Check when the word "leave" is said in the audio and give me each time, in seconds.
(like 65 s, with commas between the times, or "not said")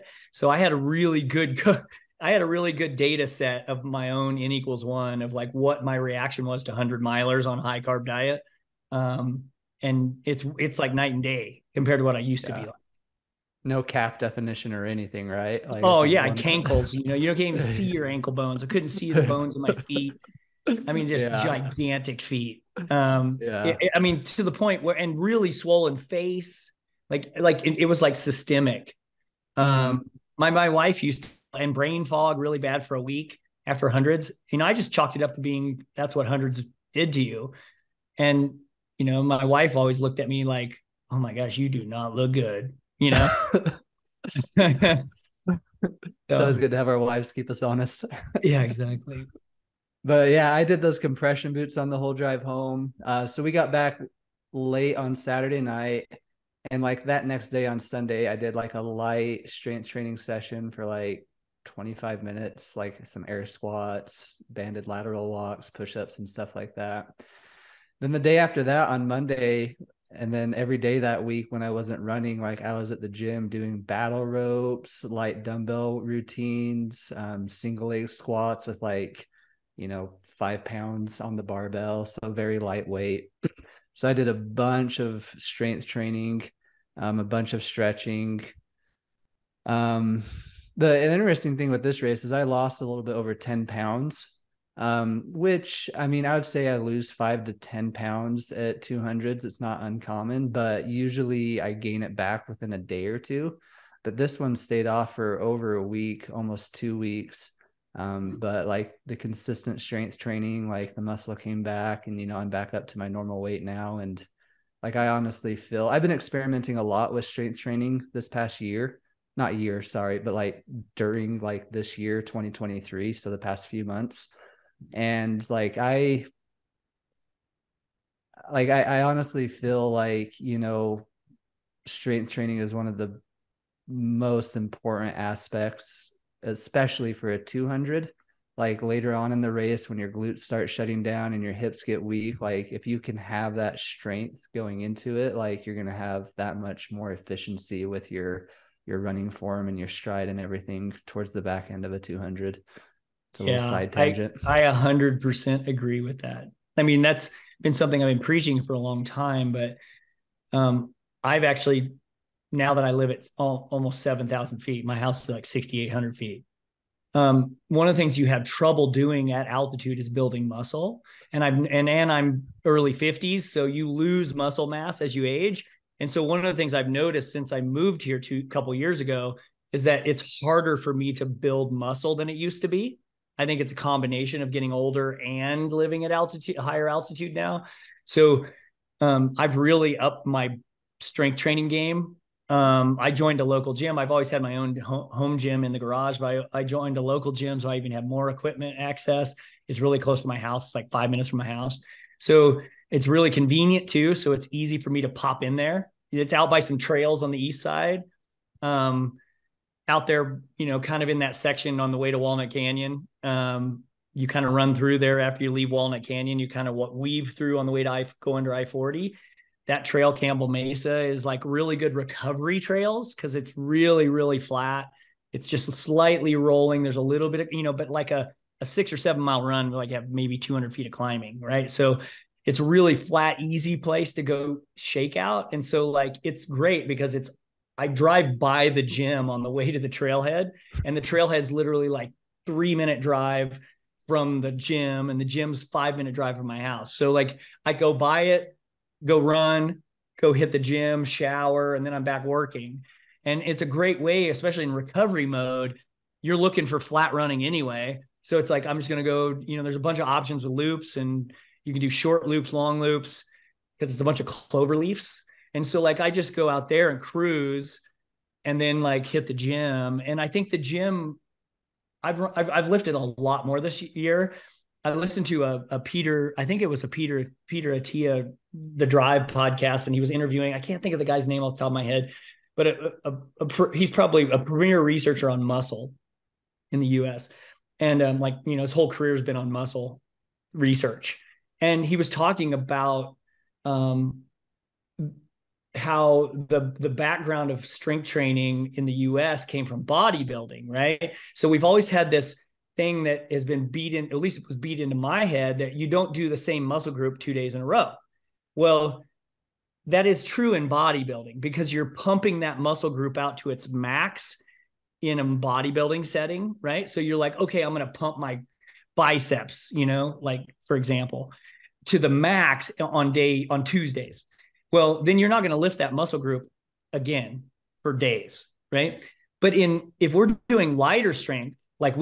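215 s, 264 s.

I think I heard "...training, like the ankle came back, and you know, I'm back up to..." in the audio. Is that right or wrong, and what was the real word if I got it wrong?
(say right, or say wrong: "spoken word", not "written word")
wrong: "muscle", not "ankle".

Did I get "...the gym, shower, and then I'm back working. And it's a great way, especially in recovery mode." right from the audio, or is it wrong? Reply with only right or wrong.
right.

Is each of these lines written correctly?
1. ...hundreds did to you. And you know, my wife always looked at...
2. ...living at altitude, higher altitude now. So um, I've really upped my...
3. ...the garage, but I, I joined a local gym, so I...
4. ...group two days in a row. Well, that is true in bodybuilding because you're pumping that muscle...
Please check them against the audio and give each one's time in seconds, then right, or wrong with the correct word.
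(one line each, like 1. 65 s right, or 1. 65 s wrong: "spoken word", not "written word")
1. 36 s right
2. 185 s right
3. 195 s right
4. 306 s right.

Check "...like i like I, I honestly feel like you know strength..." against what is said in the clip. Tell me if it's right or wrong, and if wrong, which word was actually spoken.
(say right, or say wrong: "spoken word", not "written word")
right.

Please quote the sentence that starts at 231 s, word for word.
So it's a really flat, easy place to go shake out.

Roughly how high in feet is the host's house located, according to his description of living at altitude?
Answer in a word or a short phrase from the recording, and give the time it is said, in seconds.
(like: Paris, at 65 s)
6,800 feet, at 165 s.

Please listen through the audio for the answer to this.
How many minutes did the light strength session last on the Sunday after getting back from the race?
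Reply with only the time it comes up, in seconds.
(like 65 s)
61 s.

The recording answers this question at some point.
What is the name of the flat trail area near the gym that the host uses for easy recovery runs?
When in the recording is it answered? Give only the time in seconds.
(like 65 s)
220 s.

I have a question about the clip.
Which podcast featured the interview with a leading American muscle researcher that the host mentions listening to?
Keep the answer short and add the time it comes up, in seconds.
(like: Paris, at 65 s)
The Drive, at 278 s.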